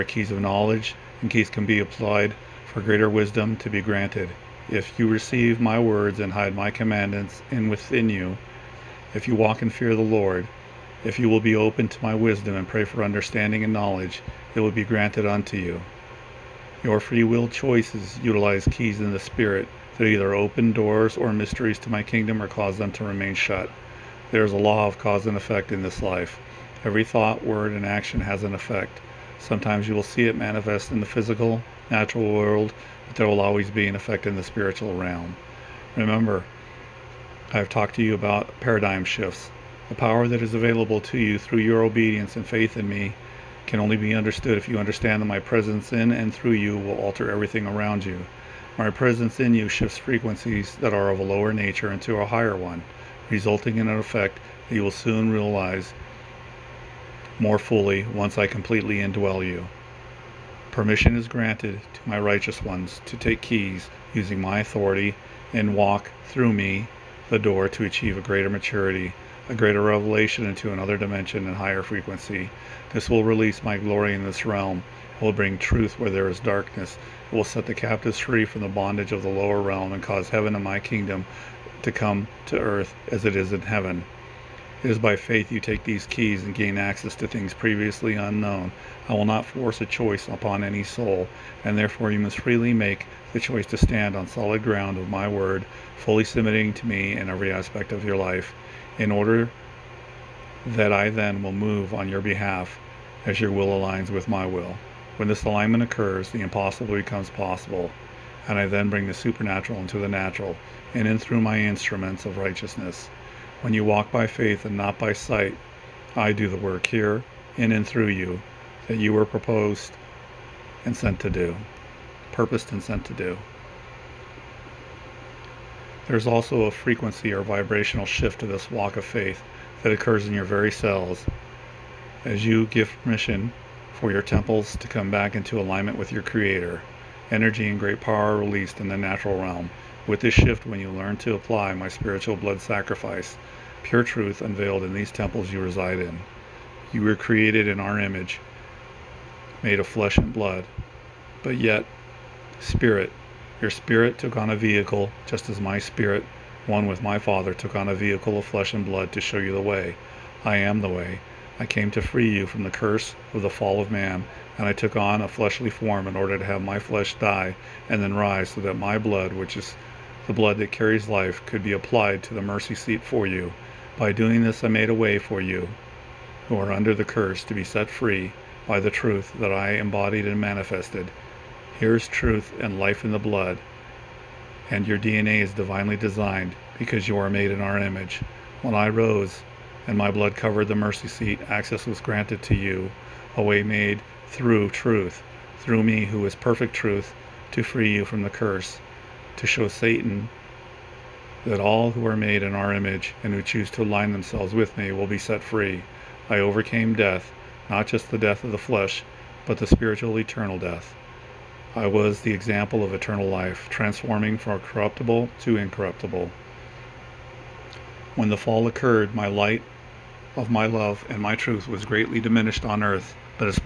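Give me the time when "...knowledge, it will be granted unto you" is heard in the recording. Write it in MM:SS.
00:13.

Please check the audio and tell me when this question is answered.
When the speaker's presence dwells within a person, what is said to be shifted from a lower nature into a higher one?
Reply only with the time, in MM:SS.
00:49.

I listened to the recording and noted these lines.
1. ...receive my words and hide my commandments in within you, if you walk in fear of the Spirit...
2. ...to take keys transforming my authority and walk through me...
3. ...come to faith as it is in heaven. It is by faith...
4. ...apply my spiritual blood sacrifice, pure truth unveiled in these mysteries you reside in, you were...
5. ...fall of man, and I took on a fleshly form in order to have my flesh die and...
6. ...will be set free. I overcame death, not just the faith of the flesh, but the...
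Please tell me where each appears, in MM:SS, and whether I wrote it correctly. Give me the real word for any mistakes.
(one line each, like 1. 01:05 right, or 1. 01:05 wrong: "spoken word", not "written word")
1. 00:05 wrong: "Lord", not "Spirit"
2. 01:03 wrong: "using", not "transforming"
3. 01:21 wrong: "earth", not "faith"
4. 02:21 wrong: "temples", not "mysteries"
5. 02:43 right
6. 03:24 wrong: "death", not "faith".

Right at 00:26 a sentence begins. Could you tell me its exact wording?
Every thought, word, and action has an effect.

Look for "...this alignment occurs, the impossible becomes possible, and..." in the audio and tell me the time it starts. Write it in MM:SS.
01:45.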